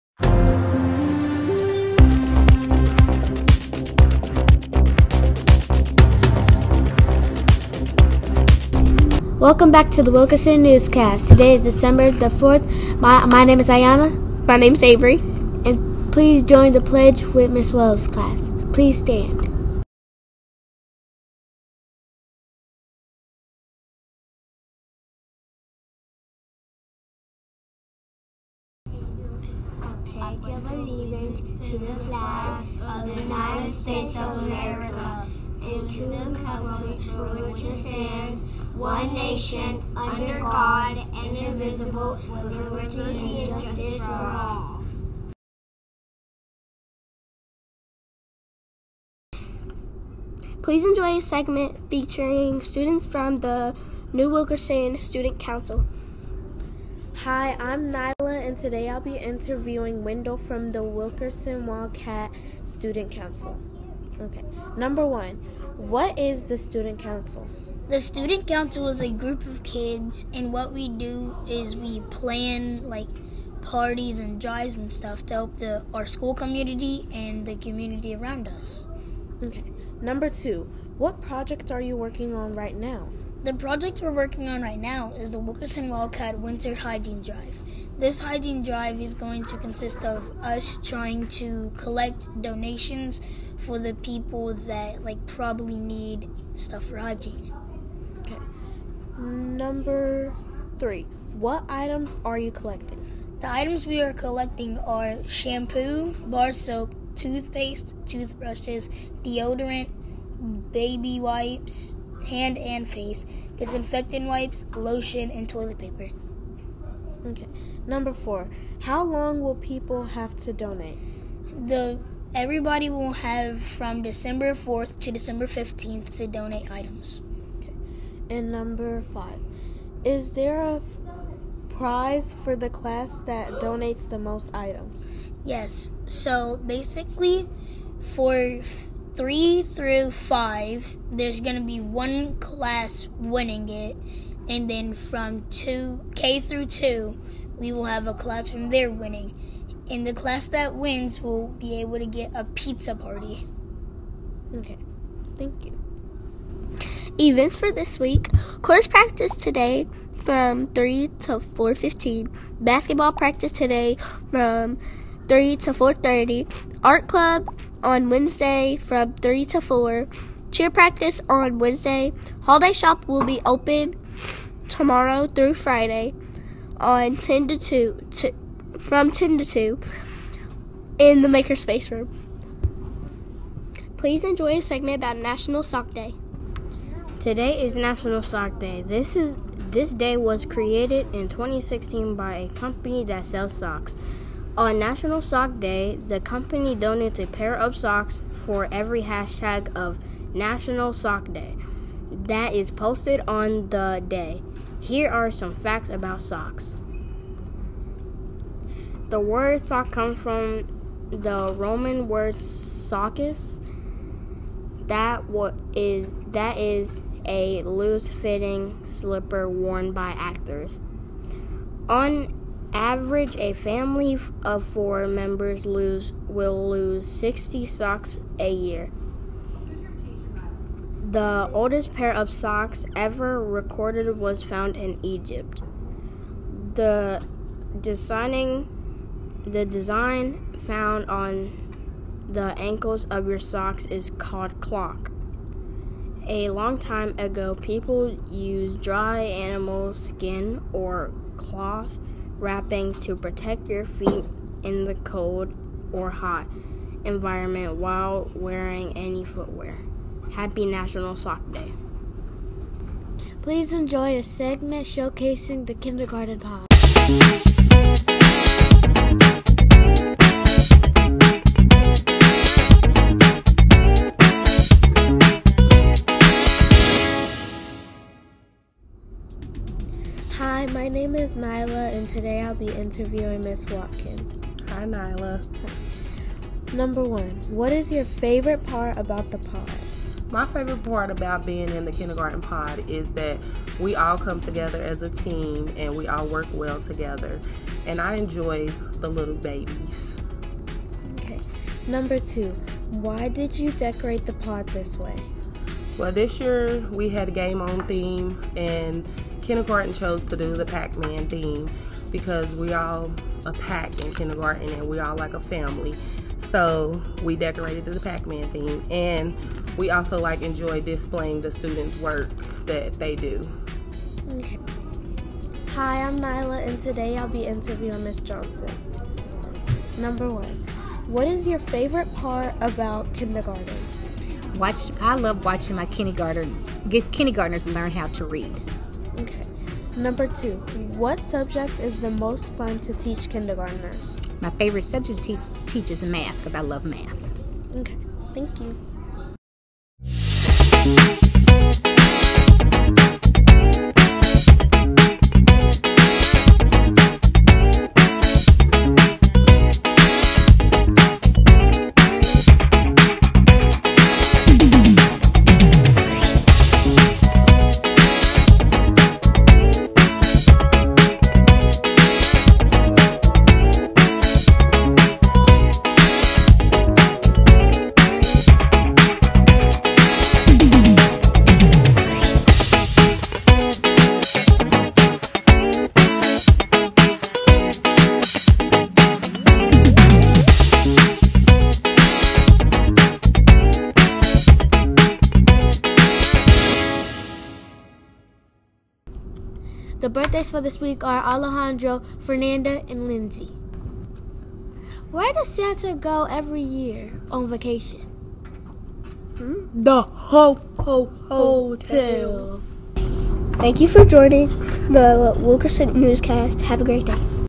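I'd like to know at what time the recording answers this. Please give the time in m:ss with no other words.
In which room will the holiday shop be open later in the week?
3:01.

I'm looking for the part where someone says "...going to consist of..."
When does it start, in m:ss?
1:29.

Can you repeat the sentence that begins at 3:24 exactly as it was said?
Here are some facts about socks.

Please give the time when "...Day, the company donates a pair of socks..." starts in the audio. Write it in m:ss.
3:15.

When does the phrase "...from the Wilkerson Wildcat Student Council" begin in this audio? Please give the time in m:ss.
1:00.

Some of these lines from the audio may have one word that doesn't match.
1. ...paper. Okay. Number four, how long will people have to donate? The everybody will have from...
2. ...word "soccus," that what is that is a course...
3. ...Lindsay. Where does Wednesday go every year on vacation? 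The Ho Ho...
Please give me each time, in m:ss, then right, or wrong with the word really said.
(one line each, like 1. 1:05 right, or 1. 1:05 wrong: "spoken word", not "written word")
1. 1:55 right
2. 3:32 wrong: "loose", not "course"
3. 6:43 wrong: "Santa", not "Wednesday".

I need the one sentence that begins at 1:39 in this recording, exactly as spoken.
Number three, what items are you collecting?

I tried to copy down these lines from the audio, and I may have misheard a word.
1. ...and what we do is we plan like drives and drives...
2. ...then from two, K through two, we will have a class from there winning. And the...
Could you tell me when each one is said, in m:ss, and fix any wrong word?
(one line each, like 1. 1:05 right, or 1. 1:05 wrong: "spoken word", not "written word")
1. 1:10 wrong: "parties", not "drives"
2. 2:24 right.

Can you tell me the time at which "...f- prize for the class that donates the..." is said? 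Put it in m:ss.
2:10.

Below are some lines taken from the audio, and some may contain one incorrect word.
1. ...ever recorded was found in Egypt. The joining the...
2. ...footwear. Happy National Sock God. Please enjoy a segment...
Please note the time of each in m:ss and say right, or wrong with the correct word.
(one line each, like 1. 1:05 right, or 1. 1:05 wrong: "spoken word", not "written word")
1. 3:52 wrong: "designing", not "joining"
2. 4:19 wrong: "Day", not "God".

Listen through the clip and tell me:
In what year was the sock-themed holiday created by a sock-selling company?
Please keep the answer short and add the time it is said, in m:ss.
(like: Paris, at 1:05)
2016, at 3:11.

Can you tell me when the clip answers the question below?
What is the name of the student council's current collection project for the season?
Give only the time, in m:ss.
1:25.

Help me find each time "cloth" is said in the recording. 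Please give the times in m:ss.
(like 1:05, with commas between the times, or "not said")
4:11.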